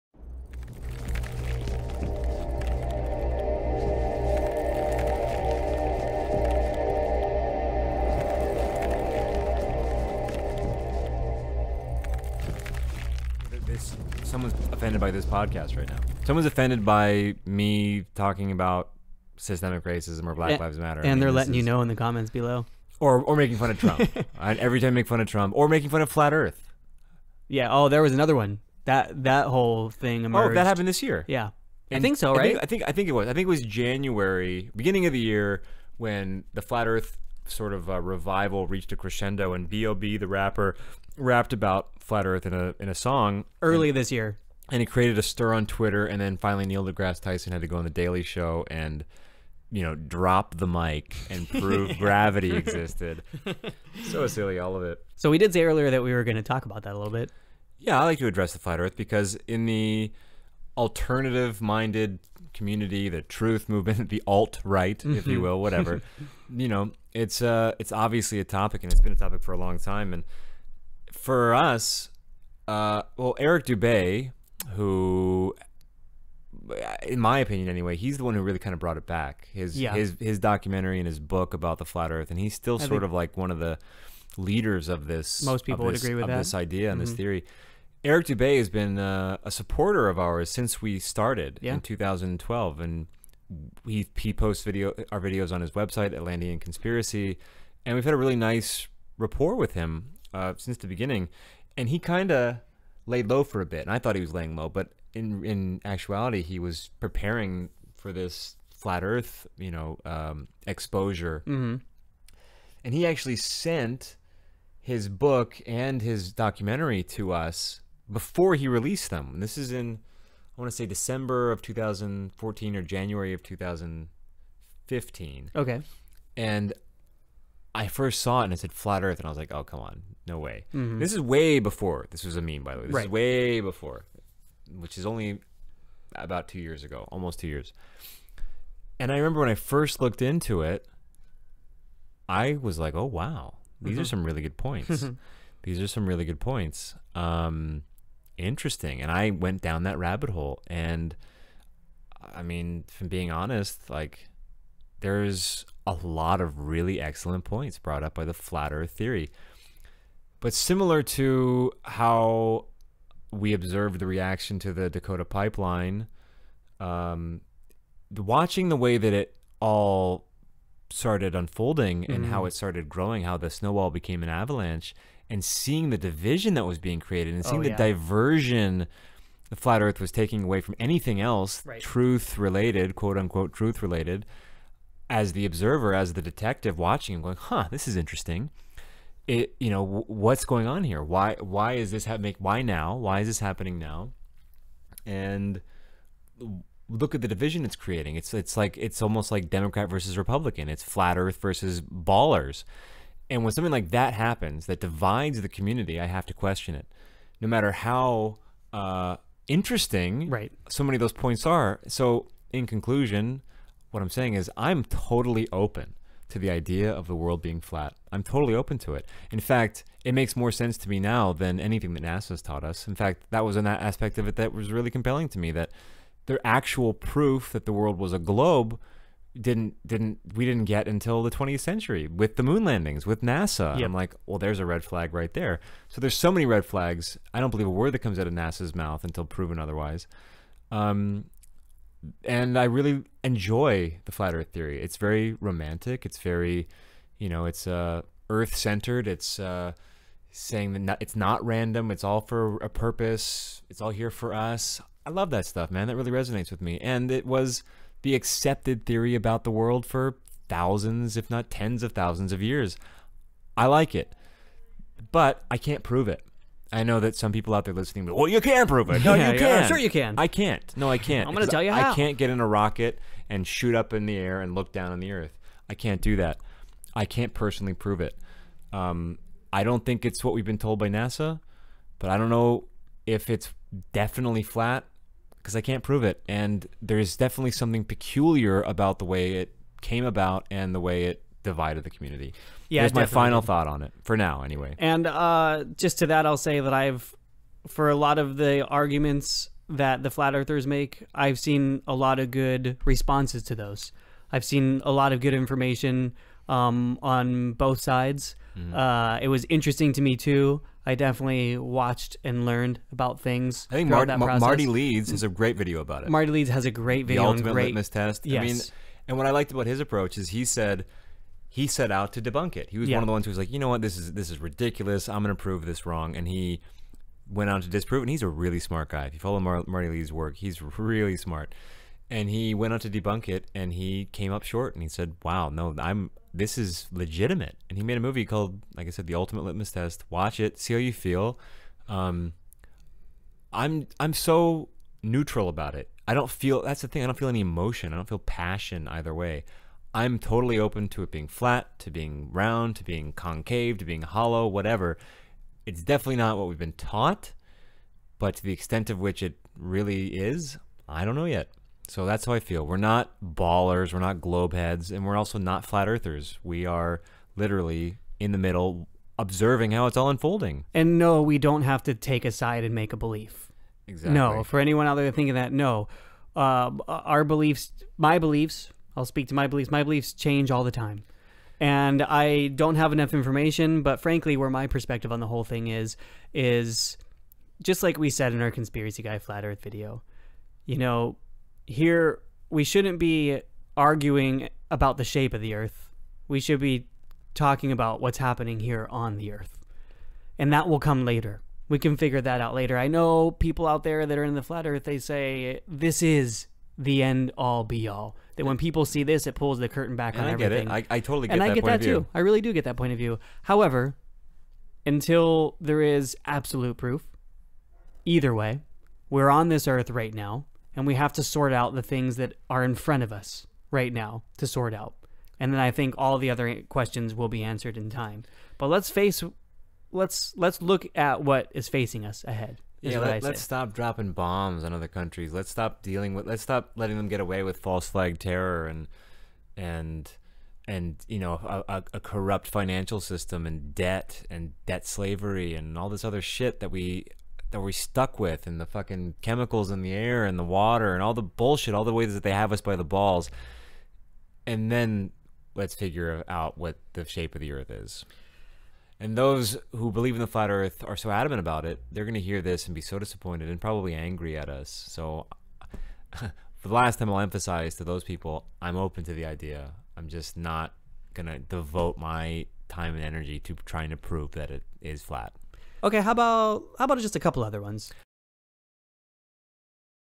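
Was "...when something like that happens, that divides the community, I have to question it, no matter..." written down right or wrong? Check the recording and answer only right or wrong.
right.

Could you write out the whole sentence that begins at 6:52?
I really do get that point of view.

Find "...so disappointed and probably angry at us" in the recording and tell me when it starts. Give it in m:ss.
7:42.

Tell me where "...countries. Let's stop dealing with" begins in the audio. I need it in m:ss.
7:14.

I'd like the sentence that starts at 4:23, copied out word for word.
I like it, but I can't prove it.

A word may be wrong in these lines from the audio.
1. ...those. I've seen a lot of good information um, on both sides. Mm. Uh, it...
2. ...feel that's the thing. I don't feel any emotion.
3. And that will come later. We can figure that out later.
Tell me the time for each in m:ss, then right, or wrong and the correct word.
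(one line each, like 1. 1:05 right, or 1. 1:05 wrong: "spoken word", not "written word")
1. 5:03 right
2. 5:46 right
3. 6:40 right.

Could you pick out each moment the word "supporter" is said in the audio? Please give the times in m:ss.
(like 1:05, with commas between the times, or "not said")
1:29.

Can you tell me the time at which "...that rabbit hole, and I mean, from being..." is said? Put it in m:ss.
2:29.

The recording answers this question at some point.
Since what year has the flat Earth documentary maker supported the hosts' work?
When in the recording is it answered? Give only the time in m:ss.
1:31.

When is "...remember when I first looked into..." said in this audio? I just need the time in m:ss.
2:19.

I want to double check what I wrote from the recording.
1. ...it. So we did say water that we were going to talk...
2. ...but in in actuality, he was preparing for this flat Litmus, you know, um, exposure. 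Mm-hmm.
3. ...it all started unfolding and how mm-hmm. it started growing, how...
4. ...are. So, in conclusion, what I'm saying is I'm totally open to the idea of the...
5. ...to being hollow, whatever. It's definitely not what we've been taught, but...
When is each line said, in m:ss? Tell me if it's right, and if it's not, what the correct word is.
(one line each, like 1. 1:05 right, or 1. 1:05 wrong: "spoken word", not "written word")
1. 0:54 wrong: "earlier", not "water"
2. 1:44 wrong: "Earth", not "Litmus"
3. 2:49 right
4. 3:31 right
5. 5:53 right.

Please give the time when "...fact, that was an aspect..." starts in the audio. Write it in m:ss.
3:42.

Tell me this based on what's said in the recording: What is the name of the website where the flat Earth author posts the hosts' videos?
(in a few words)
Atlantean Conspiracy.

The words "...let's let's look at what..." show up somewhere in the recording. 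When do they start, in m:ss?
7:09.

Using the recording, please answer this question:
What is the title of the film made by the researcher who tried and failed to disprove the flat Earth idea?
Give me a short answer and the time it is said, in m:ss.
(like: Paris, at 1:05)
The Ultimate Litmus Test, at 5:39.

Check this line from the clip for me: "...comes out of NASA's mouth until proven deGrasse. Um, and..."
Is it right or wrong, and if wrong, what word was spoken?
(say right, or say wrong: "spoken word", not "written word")
wrong: "otherwise", not "deGrasse".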